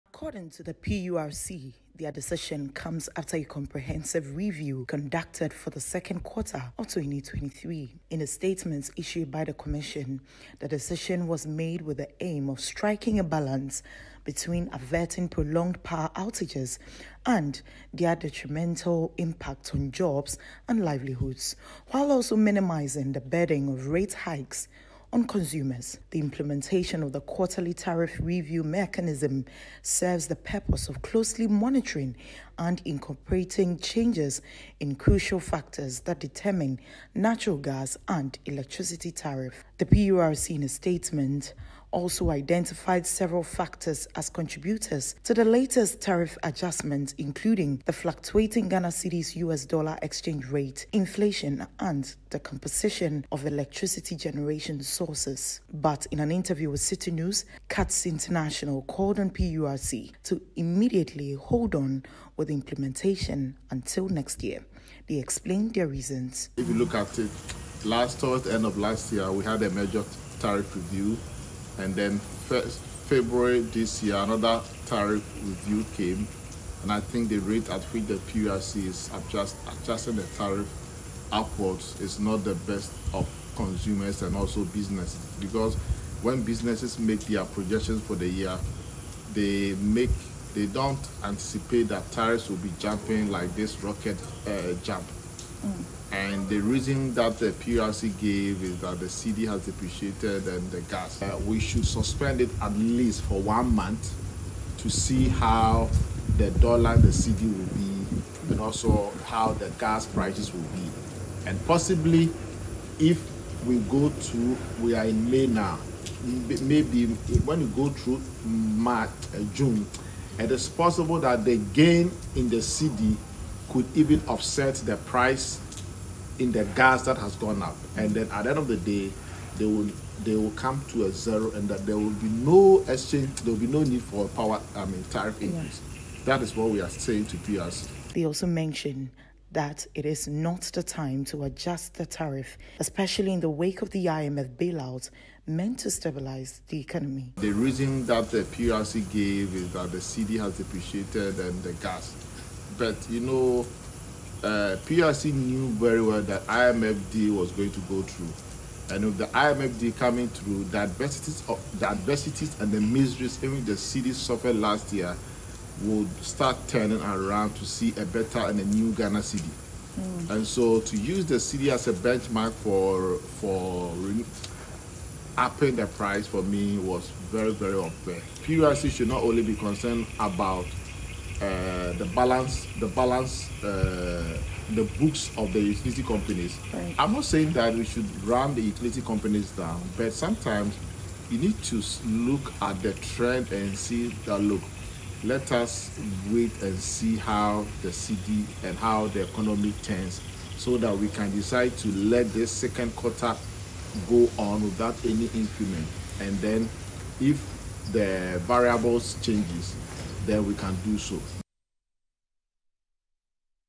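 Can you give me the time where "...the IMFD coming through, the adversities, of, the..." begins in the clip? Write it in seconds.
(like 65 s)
159 s.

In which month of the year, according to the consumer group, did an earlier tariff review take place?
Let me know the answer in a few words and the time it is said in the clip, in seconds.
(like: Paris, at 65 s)
February, at 72 s.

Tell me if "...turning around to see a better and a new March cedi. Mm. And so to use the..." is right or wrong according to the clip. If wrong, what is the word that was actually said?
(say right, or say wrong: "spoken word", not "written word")
wrong: "Ghana", not "March".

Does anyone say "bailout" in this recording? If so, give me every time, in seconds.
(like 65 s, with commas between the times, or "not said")
144 s.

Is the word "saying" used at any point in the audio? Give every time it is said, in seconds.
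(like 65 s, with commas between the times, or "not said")
136 s, 187 s.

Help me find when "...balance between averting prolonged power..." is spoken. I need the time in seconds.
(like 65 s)
13 s.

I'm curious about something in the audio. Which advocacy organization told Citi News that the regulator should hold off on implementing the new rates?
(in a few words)
CUTS International.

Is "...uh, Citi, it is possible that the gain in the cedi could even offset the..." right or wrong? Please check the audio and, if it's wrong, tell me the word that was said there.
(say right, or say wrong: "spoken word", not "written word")
wrong: "June", not "Citi".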